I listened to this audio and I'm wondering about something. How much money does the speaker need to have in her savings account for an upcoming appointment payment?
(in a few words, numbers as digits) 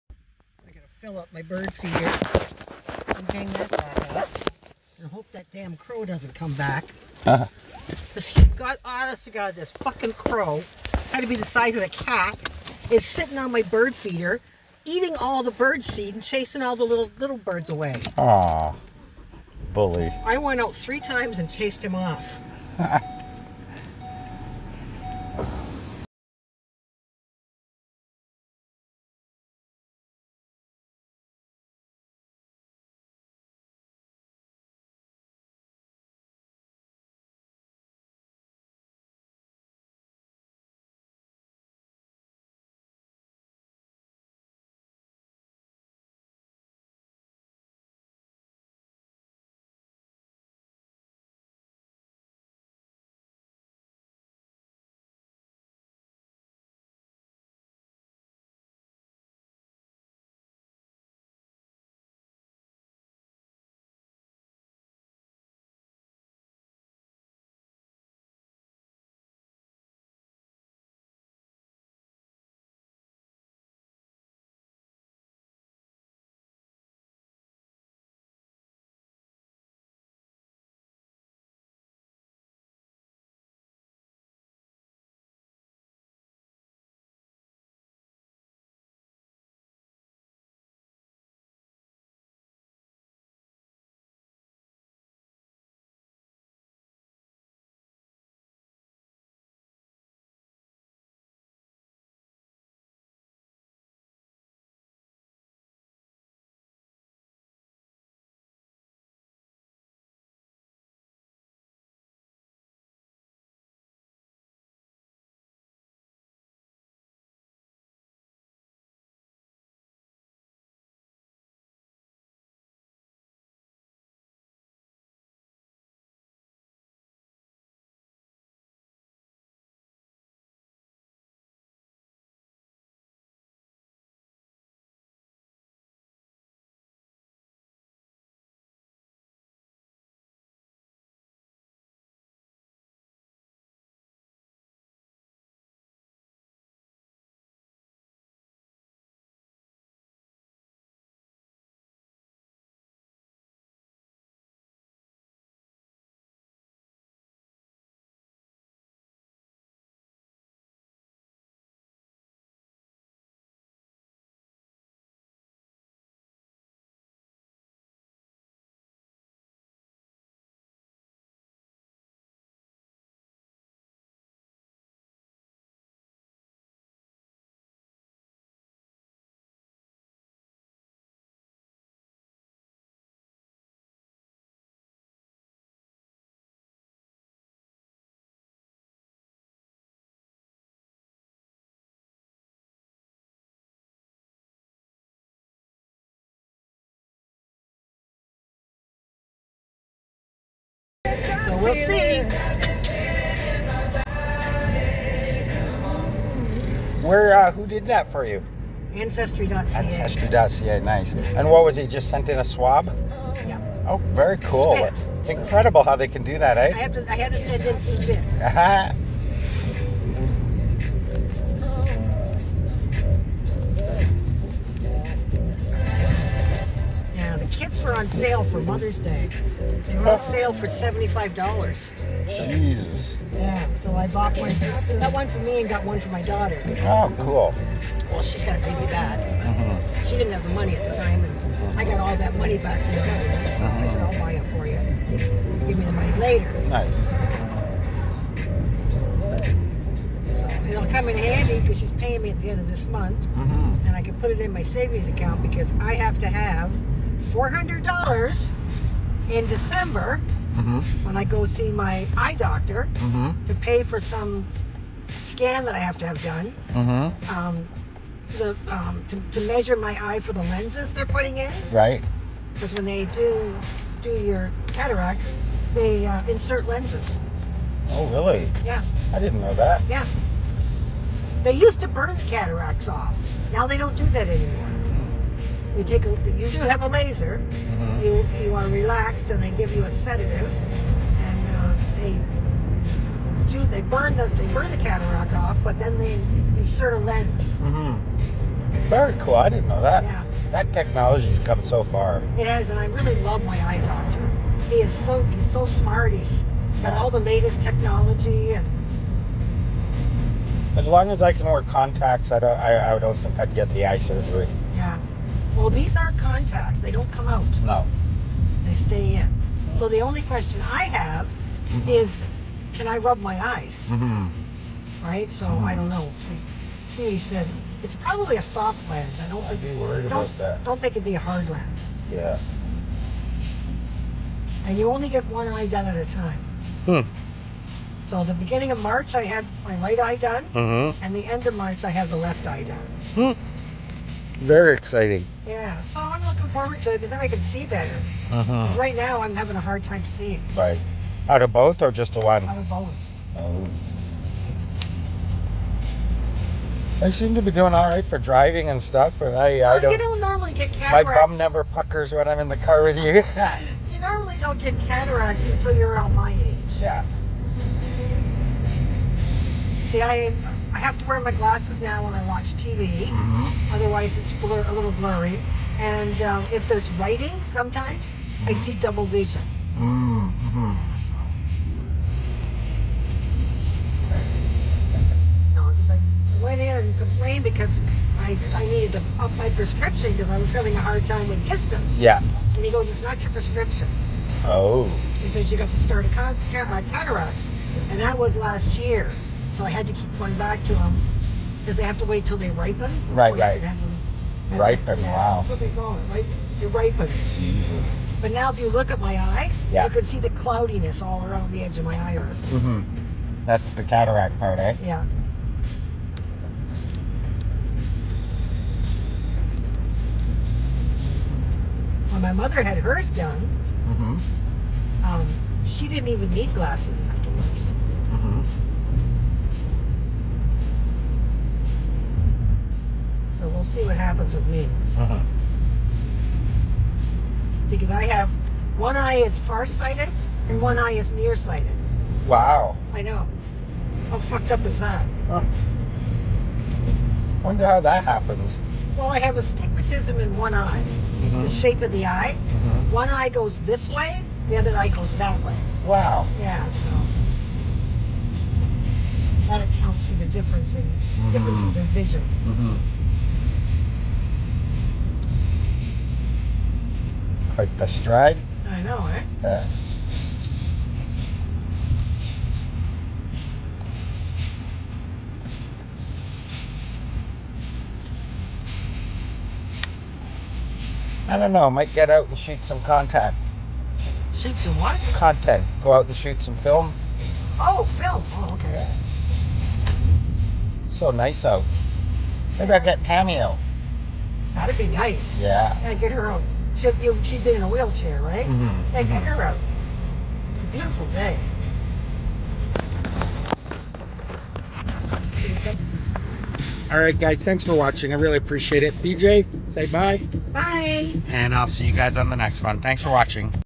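$400.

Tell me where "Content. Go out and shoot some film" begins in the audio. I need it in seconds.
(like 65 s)
485 s.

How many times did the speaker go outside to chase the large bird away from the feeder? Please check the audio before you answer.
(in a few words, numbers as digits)
3.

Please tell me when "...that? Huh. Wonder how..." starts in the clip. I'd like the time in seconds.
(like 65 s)
444 s.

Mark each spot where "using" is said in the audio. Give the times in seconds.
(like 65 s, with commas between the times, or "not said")
not said.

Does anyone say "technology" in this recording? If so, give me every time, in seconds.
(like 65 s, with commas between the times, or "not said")
300 s, 307 s.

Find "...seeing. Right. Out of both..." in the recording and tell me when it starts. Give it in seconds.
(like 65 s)
350 s.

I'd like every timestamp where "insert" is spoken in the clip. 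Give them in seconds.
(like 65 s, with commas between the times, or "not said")
276 s, 296 s.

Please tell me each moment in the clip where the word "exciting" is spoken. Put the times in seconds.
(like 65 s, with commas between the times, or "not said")
344 s.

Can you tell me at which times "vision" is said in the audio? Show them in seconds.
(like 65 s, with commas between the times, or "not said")
379 s, 461 s.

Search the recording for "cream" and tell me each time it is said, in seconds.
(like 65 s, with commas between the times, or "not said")
not said.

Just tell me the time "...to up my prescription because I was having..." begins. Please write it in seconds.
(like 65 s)
388 s.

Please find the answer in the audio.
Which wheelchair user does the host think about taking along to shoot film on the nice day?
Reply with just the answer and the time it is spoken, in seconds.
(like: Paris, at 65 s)
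Tammy, at 493 s.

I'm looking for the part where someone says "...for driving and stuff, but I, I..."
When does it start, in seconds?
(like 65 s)
358 s.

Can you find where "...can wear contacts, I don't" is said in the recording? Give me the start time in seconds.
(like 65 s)
311 s.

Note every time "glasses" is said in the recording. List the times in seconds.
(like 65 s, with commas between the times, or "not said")
371 s, 426 s.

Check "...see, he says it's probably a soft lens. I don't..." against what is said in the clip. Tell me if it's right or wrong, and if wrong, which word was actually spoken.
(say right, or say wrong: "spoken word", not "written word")
right.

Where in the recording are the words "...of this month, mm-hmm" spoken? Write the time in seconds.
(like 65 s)
252 s.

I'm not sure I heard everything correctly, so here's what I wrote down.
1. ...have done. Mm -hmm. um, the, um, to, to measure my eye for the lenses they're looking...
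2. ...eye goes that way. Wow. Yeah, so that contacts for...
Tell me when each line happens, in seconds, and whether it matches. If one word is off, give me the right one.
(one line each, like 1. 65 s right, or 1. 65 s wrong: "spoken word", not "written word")
1. 266 s wrong: "putting", not "looking"
2. 454 s wrong: "accounts", not "contacts".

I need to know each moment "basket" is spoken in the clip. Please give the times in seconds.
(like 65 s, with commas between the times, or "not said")
not said.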